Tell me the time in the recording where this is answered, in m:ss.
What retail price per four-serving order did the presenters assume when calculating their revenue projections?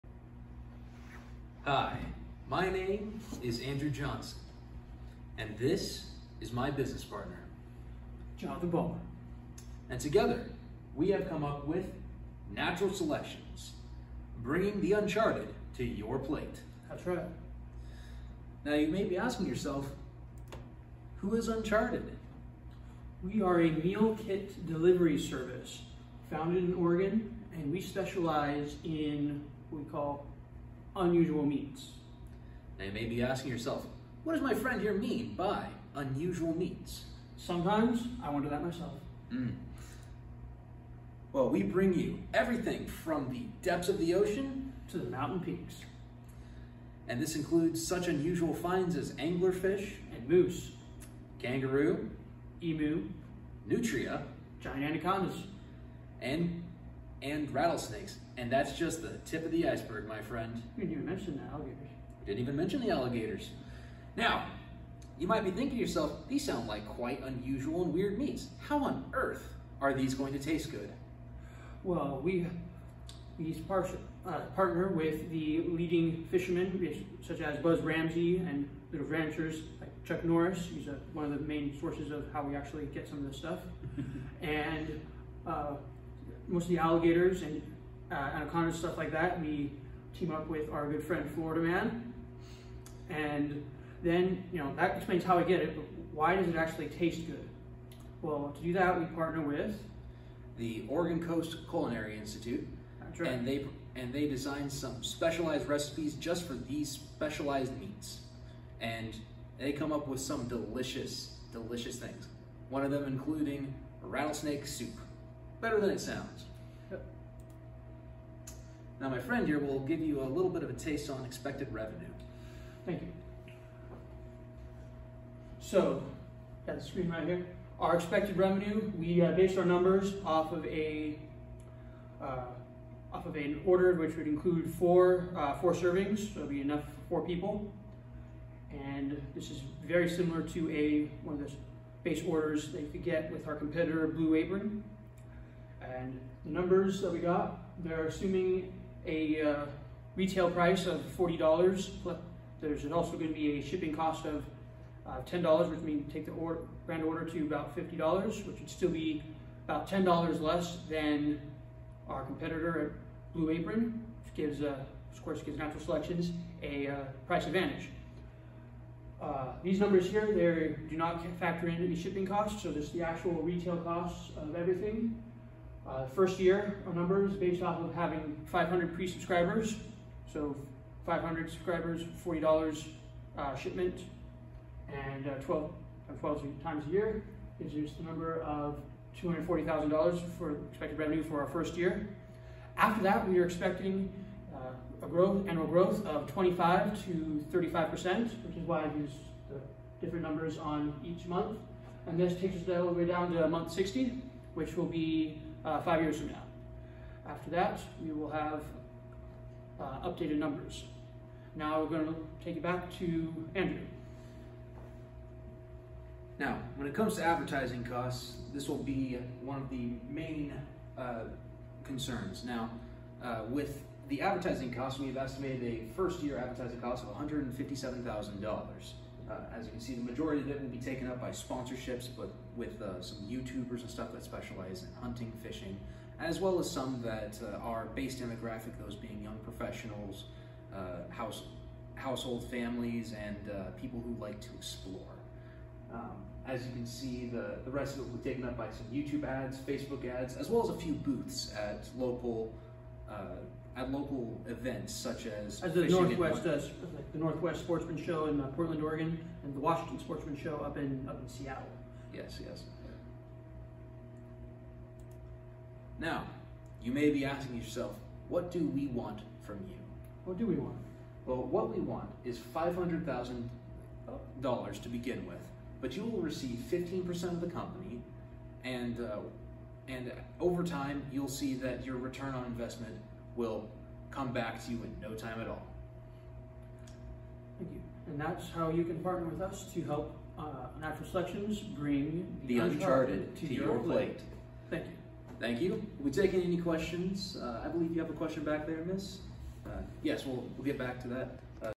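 2:30.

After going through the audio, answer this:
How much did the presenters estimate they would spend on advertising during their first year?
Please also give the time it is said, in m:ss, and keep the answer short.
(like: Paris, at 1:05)
$157,000, at 3:47.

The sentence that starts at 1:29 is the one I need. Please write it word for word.
We team up with our good friend Florida Man.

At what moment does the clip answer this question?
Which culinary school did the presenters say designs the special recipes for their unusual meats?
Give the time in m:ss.
1:40.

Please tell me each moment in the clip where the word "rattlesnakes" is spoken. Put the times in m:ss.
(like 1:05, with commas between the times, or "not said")
0:57, 1:54.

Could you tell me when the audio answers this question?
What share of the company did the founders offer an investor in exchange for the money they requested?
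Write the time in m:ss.
4:36.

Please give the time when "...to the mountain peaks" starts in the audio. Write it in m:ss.
0:44.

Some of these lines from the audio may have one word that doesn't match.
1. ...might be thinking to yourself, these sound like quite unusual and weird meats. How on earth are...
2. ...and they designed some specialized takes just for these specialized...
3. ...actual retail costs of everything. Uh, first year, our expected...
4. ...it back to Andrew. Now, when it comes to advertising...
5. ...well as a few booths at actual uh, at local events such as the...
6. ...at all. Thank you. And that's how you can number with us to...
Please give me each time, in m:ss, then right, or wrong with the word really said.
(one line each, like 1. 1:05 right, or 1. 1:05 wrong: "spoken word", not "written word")
1. 1:05 right
2. 1:43 wrong: "recipes", not "takes"
3. 2:53 wrong: "based", not "expected"
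4. 3:32 right
5. 4:10 wrong: "local", not "actual"
6. 4:45 wrong: "partner", not "number".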